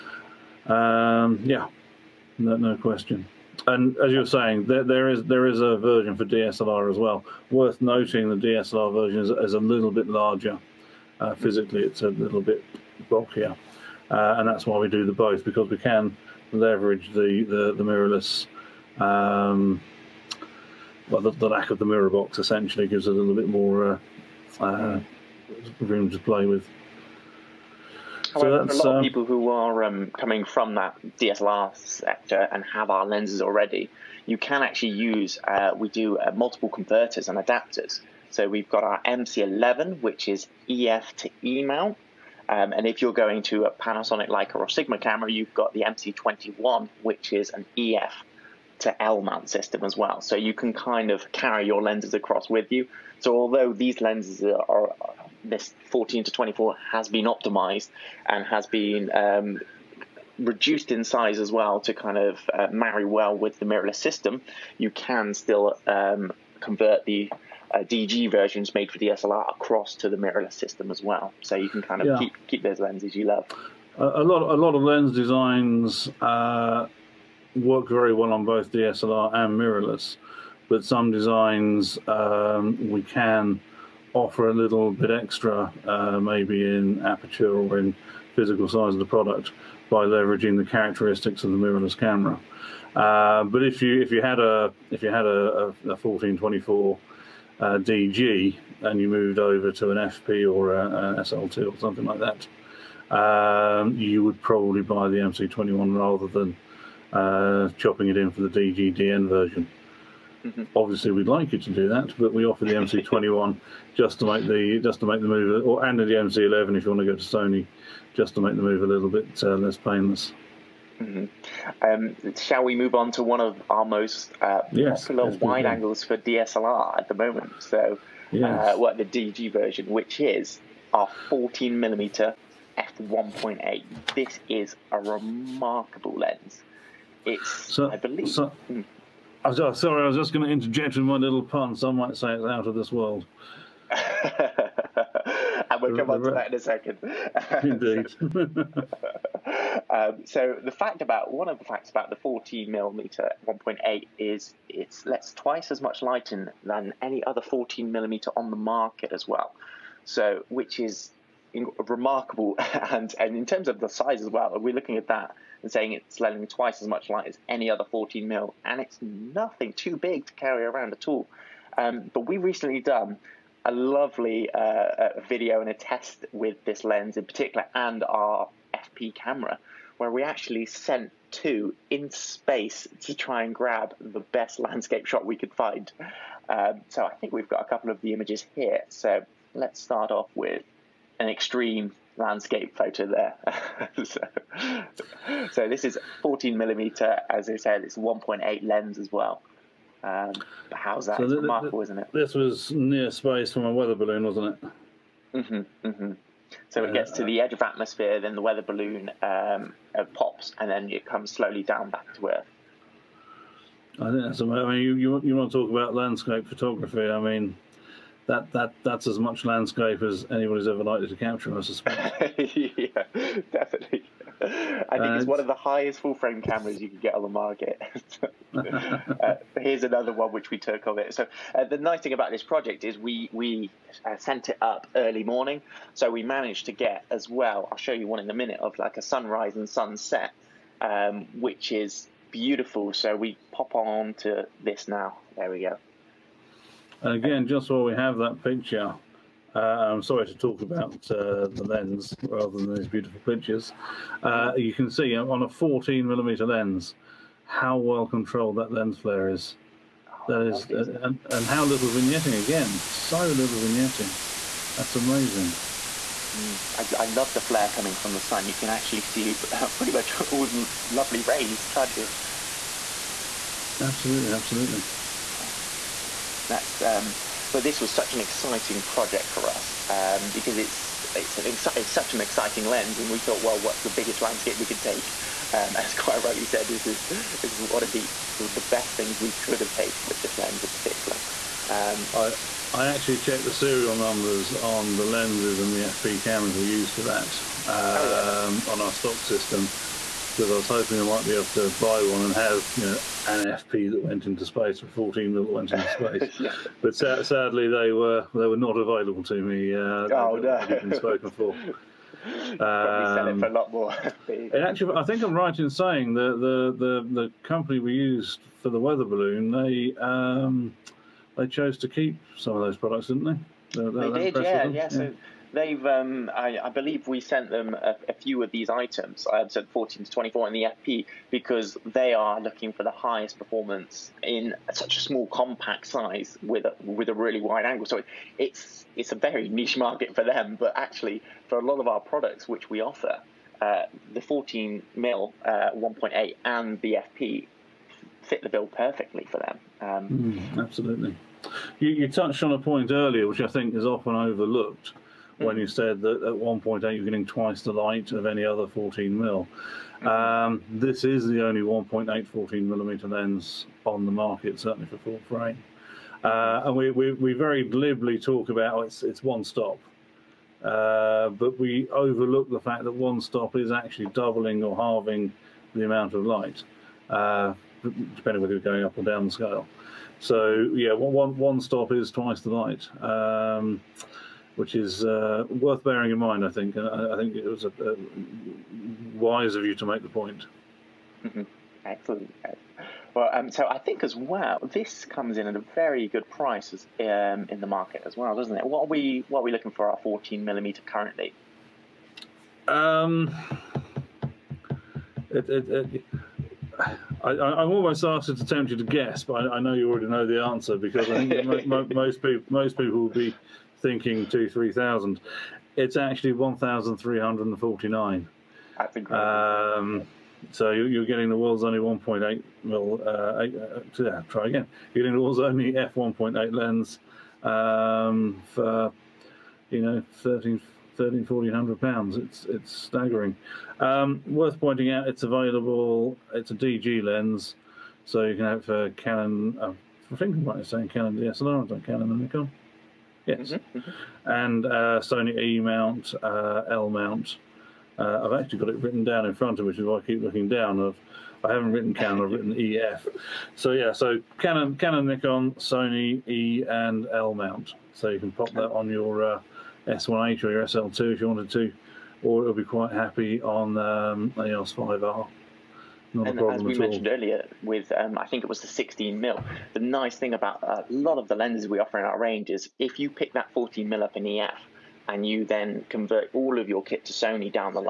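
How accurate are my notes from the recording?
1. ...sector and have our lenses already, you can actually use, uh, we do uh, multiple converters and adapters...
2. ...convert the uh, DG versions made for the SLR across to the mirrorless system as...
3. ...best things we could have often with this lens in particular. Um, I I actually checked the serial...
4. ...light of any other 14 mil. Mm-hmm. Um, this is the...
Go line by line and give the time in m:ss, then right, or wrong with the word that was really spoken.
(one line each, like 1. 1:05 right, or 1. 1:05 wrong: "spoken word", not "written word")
1. 0:31 right
2. 1:06 right
3. 4:48 wrong: "taken", not "often"
4. 5:57 right.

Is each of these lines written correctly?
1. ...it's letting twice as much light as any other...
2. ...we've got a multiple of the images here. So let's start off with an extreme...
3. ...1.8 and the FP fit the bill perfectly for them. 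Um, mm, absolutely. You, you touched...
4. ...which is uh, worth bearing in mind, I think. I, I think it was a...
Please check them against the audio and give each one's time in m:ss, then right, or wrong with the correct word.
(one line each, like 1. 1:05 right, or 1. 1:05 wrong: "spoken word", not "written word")
1. 2:45 right
2. 3:07 wrong: "couple", not "multiple"
3. 5:45 right
4. 6:24 right.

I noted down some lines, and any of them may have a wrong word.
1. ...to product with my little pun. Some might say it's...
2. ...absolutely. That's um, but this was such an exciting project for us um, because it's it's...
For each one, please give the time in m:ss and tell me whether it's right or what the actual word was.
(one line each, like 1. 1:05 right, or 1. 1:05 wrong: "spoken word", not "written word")
1. 2:20 wrong: "interject", not "product"
2. 4:34 right.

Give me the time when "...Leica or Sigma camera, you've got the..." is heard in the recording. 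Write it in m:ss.
0:44.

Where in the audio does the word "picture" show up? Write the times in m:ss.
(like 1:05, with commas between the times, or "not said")
4:08, 4:13.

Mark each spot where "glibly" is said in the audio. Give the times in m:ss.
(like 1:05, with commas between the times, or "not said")
6:07.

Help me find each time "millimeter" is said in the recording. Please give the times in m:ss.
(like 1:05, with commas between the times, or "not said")
2:11, 2:32, 2:37, 3:16, 4:16, 6:02, 6:40.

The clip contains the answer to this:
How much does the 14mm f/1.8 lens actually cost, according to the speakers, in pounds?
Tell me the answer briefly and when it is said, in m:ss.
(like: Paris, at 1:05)
1349, at 6:56.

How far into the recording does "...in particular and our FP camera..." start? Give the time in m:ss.
2:57.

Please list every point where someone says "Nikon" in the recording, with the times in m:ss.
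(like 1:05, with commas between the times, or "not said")
7:22, 7:35.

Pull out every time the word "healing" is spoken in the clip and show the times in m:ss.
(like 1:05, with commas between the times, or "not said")
not said.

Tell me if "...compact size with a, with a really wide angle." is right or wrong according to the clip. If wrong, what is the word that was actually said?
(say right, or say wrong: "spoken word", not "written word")
right.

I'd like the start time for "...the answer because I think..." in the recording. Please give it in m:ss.
6:50.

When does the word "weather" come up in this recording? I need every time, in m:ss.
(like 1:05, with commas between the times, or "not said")
3:23, 3:28, 5:18.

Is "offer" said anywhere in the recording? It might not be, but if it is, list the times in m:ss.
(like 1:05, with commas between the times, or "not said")
1:24, 1:52, 5:42, 7:51.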